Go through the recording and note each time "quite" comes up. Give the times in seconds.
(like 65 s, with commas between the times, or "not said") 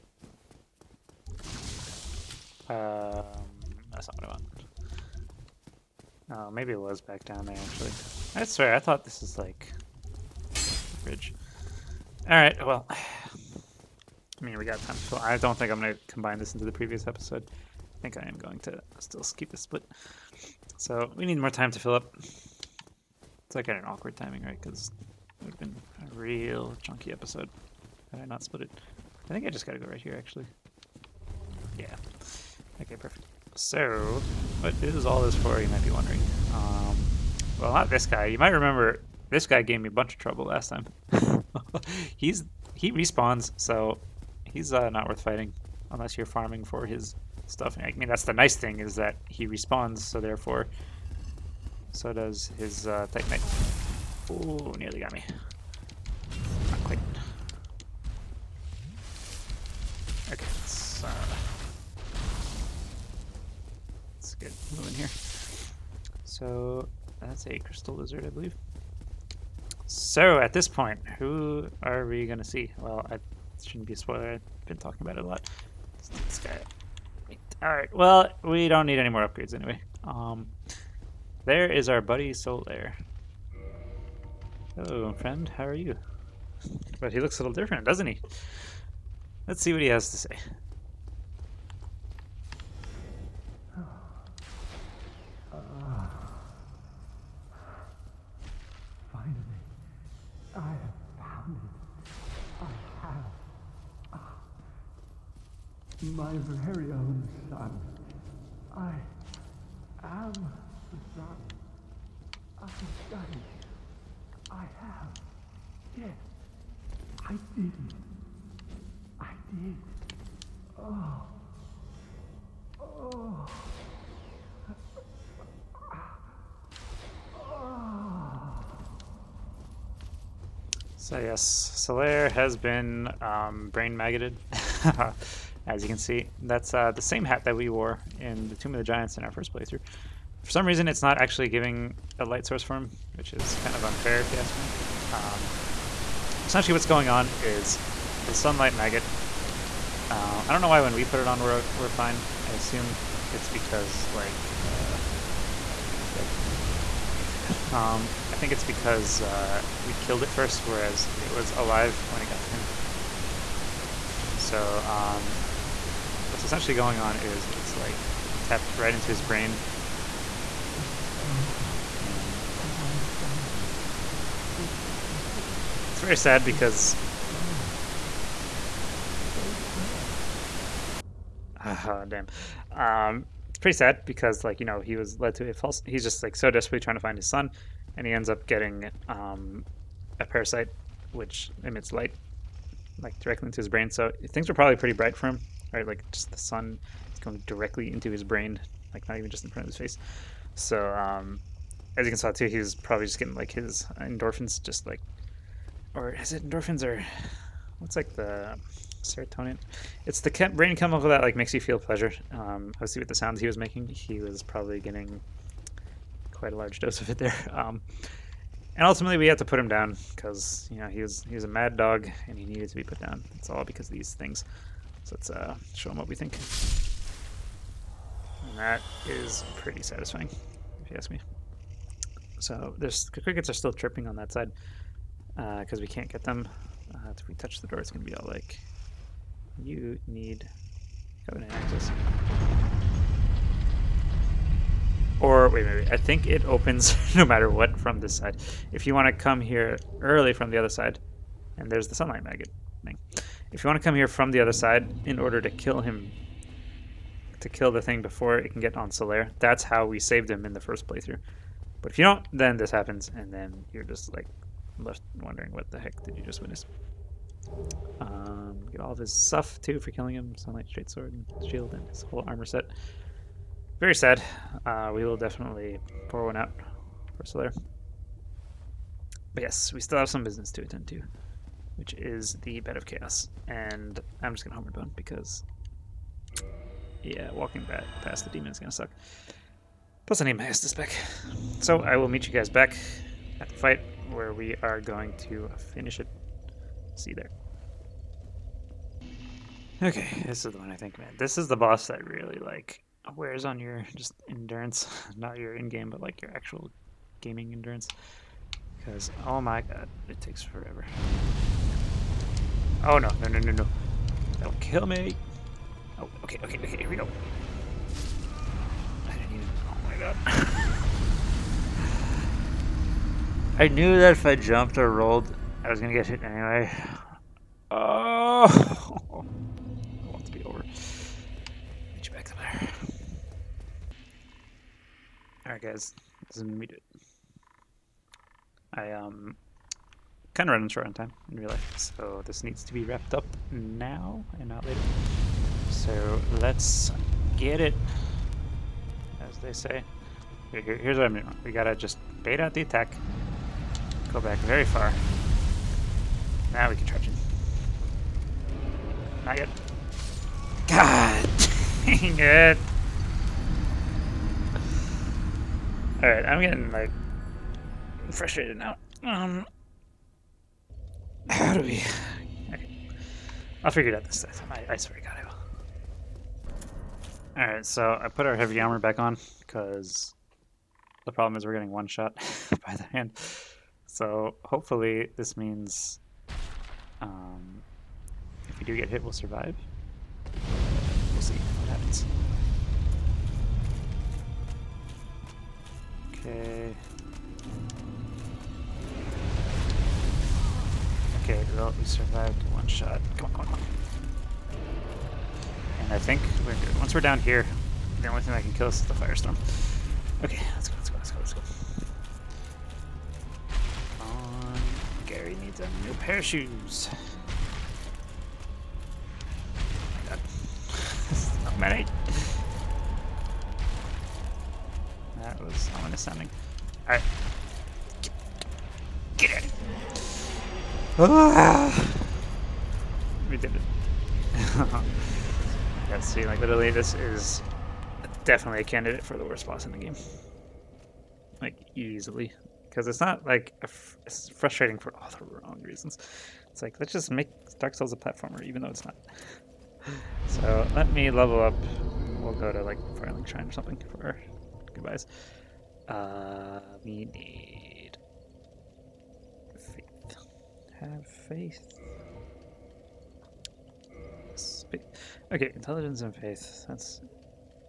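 56 s, 216 s.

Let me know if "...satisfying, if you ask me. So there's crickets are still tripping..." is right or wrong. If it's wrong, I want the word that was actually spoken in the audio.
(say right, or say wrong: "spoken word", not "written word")
right.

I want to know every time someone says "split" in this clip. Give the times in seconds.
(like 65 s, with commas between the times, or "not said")
19 s, 28 s.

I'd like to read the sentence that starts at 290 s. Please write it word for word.
Plus, I need my Estus back.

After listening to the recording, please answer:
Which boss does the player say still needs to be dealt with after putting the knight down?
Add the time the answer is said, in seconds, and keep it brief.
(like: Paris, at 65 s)
Bed of Chaos, at 282 s.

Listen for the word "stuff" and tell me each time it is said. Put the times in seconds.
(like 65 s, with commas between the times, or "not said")
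47 s, 269 s.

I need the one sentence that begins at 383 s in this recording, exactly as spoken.
So hopefully this means um, if we do get hit, we'll survive.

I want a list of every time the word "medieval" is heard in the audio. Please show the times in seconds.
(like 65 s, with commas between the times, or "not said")
not said.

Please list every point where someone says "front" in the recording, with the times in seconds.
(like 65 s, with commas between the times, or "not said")
199 s.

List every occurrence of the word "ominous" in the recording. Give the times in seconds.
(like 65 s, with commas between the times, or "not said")
425 s.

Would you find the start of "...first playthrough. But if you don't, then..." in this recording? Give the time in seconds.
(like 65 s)
260 s.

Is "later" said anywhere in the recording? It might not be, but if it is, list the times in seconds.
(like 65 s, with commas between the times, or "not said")
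344 s.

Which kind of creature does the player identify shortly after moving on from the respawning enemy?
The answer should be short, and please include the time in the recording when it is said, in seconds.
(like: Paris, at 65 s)
crystal lizard, at 67 s.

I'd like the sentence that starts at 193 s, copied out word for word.
So things were probably pretty bright for him.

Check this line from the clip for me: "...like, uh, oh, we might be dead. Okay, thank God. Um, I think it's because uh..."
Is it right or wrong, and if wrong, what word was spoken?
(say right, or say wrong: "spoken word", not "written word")
right.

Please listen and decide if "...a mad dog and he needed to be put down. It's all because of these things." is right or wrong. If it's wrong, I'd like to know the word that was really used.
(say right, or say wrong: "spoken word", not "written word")
right.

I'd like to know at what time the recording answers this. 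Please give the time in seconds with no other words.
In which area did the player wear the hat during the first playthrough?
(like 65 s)
138 s.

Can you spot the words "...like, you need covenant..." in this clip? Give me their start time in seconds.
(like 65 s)
238 s.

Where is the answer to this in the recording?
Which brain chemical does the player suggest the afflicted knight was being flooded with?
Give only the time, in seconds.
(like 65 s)
209 s.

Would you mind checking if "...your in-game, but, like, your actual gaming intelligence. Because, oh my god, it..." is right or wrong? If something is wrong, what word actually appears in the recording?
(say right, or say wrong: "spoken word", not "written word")
wrong: "endurance", not "intelligence".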